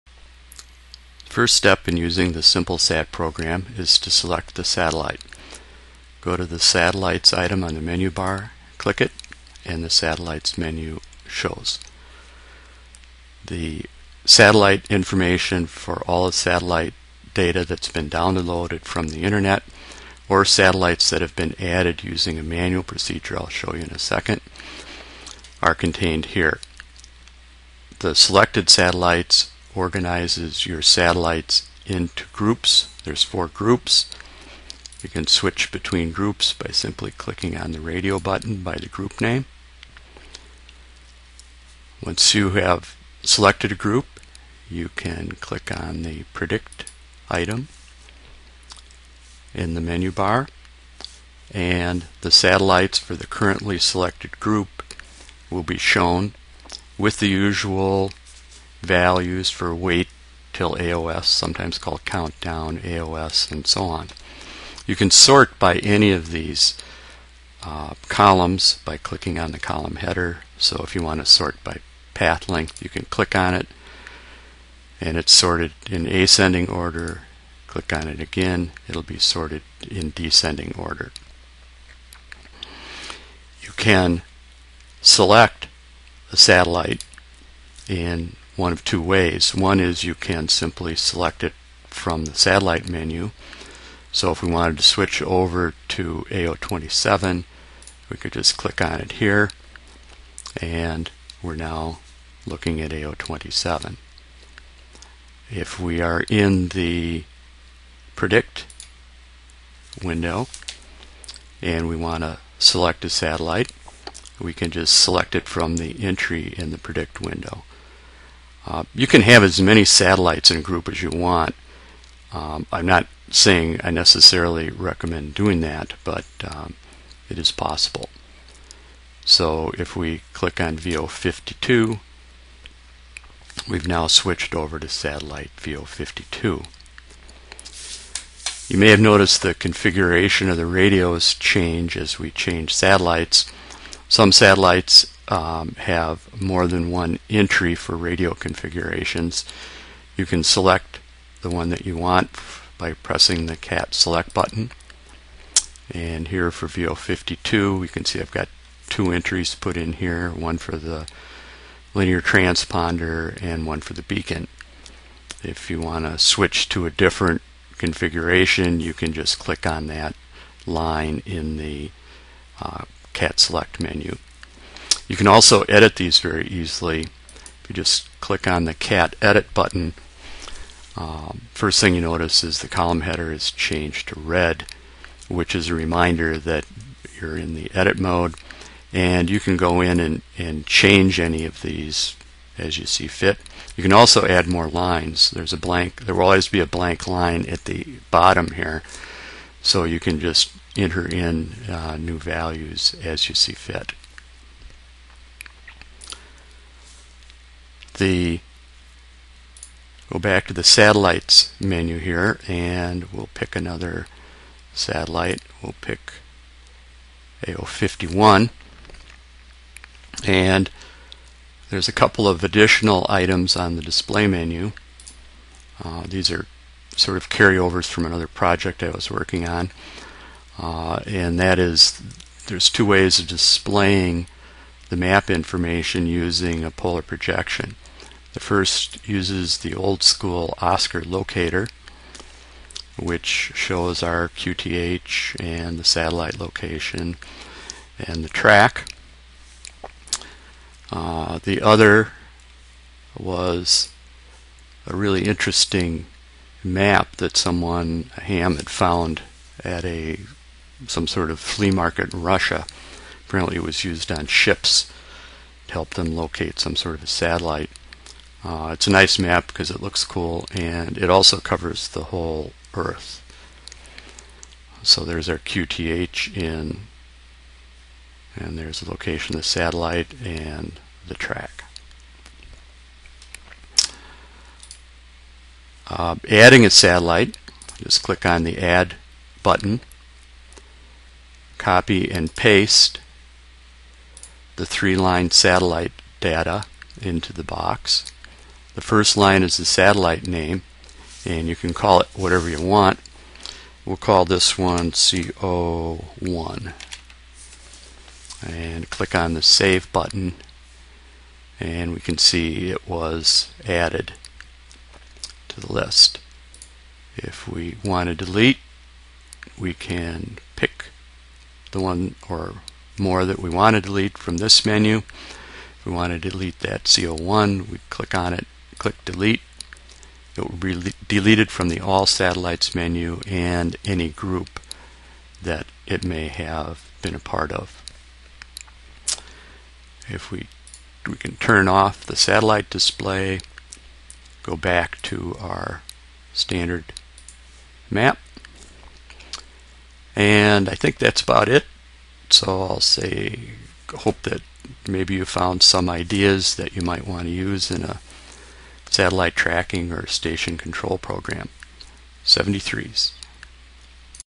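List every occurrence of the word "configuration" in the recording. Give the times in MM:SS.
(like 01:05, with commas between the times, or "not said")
02:19, 02:28, 02:47.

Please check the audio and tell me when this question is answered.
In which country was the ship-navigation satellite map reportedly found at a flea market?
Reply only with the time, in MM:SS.
04:22.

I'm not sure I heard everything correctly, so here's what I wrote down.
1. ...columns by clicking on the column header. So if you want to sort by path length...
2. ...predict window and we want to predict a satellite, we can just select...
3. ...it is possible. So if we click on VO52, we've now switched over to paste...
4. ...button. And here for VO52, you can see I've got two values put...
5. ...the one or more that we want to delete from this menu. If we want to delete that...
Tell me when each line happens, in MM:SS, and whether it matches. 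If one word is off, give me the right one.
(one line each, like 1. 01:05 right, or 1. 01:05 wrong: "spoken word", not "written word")
1. 01:08 right
2. 01:48 wrong: "select", not "predict"
3. 02:07 wrong: "satellite", not "paste"
4. 02:34 wrong: "entries", not "values"
5. 05:21 right.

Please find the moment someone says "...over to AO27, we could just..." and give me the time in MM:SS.
01:35.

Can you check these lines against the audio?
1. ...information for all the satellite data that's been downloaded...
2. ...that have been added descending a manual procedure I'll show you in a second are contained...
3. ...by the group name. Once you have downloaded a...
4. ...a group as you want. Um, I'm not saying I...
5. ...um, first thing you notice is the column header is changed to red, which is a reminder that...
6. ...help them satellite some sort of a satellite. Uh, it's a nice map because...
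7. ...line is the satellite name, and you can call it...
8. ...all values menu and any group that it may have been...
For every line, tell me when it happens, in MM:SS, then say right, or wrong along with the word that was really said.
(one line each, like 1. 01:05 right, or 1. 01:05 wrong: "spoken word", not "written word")
1. 00:14 right
2. 00:21 wrong: "using", not "descending"
3. 00:38 wrong: "selected", not "downloaded"
4. 02:00 right
5. 03:00 right
6. 04:25 wrong: "locate", not "satellite"
7. 04:59 right
8. 05:31 wrong: "satellites", not "values".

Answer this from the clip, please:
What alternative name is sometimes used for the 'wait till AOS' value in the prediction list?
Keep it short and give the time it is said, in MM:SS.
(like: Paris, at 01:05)
countdown, at 01:02.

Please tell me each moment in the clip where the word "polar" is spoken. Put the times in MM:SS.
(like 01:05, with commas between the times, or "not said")
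03:56.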